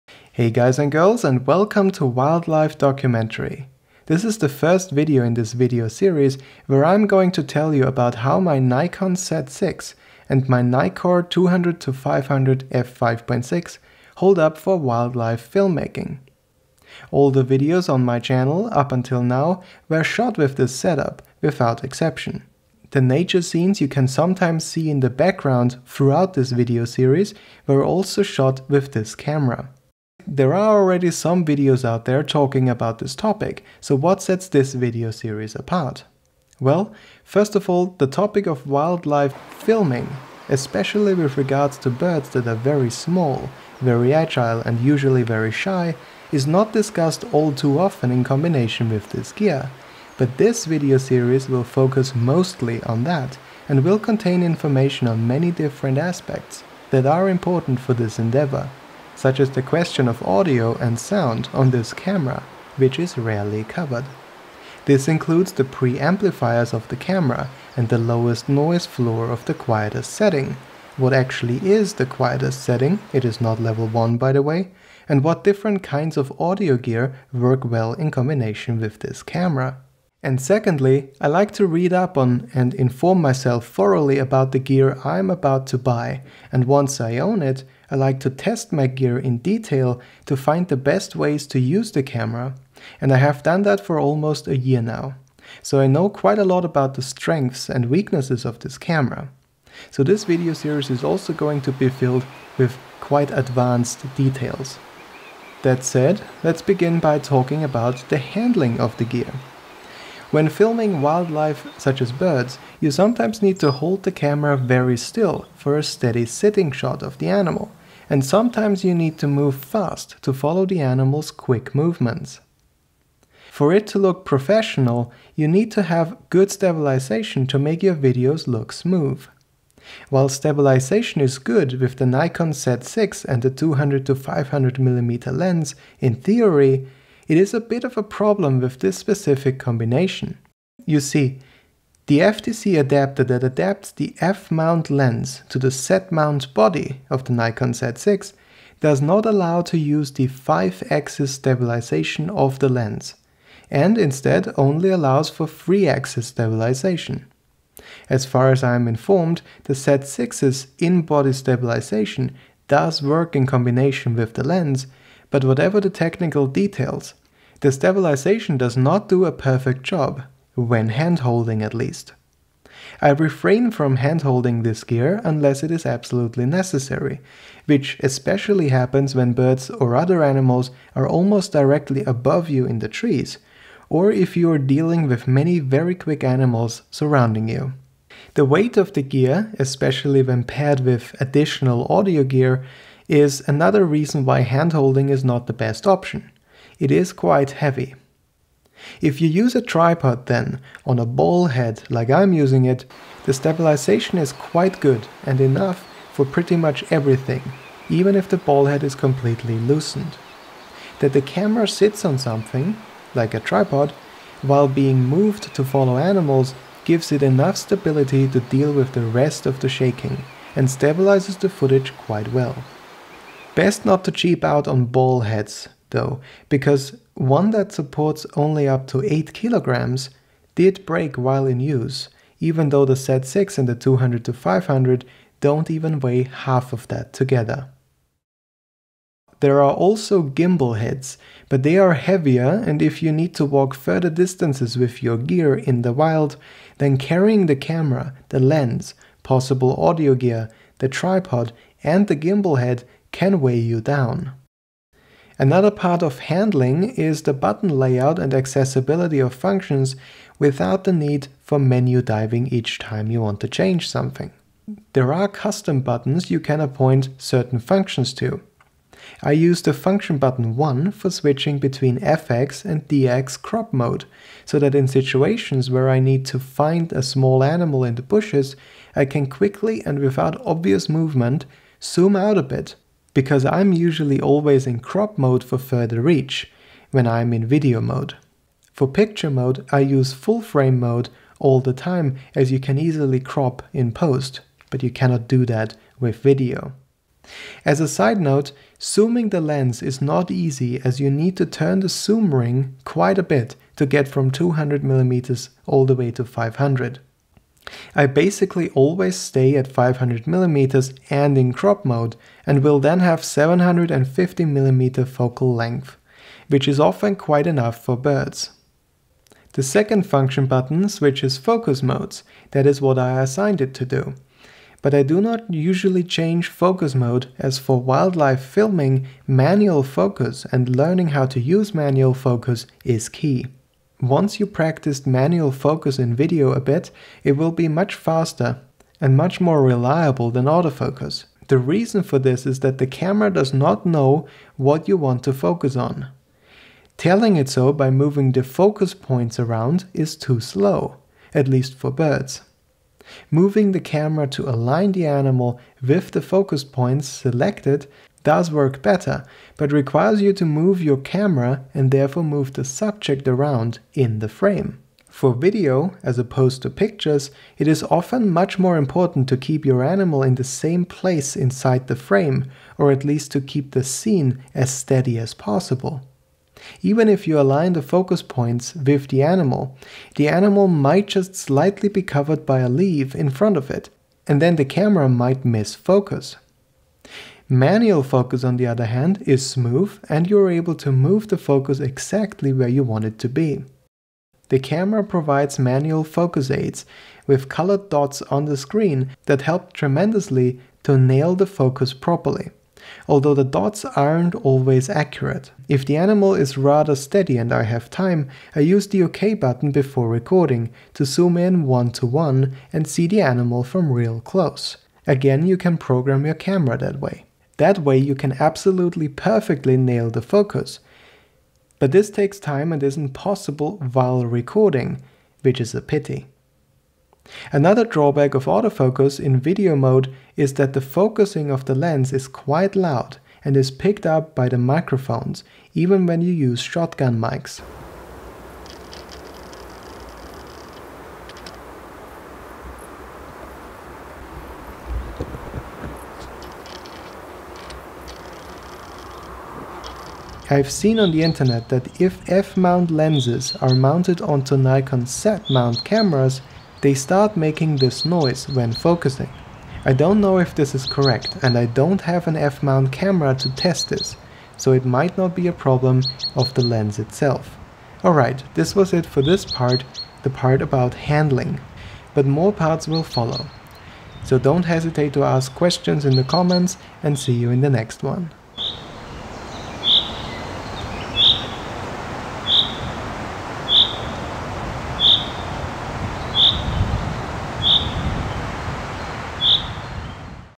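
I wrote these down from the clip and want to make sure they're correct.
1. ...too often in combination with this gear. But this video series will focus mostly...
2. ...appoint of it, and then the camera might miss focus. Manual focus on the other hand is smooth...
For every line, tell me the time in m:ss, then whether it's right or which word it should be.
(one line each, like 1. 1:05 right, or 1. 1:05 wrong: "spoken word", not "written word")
1. 0:47 right
2. 6:23 wrong: "front", not "appoint".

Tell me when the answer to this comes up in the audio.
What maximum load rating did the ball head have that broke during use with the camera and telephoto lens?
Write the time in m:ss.
3:49.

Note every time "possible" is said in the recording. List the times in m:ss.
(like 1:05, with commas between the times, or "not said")
4:09, 6:15, 7:03.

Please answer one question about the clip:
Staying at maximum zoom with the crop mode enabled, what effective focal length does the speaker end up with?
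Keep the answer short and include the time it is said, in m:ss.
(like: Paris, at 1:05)
750mm, at 5:13.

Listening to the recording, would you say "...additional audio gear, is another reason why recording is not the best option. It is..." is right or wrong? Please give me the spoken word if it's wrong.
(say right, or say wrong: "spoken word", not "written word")
wrong: "handholding", not "recording".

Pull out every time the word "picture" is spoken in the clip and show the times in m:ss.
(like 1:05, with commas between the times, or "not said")
4:48, 6:06.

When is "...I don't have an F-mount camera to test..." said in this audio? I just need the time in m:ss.
7:41.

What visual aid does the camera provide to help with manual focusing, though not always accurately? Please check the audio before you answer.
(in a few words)
Colored dots.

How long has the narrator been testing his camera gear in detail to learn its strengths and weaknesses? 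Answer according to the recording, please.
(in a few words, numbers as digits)
Almost a year.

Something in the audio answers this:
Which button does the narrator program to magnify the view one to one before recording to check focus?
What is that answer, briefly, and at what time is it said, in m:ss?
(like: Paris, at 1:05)
OK button, at 6:49.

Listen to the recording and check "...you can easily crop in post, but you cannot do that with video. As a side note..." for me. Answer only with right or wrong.
right.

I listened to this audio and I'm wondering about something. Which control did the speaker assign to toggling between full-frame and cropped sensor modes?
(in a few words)
Function button 1.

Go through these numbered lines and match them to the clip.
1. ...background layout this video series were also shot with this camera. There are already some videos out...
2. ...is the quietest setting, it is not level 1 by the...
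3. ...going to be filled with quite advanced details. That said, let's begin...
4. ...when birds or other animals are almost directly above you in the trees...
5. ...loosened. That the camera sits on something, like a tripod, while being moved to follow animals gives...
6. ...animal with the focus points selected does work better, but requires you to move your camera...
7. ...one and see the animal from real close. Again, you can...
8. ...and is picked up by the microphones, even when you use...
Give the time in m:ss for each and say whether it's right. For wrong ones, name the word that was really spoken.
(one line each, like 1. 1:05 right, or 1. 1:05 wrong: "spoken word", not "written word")
1. 0:25 wrong: "throughout", not "layout"
2. 1:11 right
3. 1:41 right
4. 2:59 right
5. 3:29 right
6. 5:55 right
7. 6:52 right
8. 7:13 right.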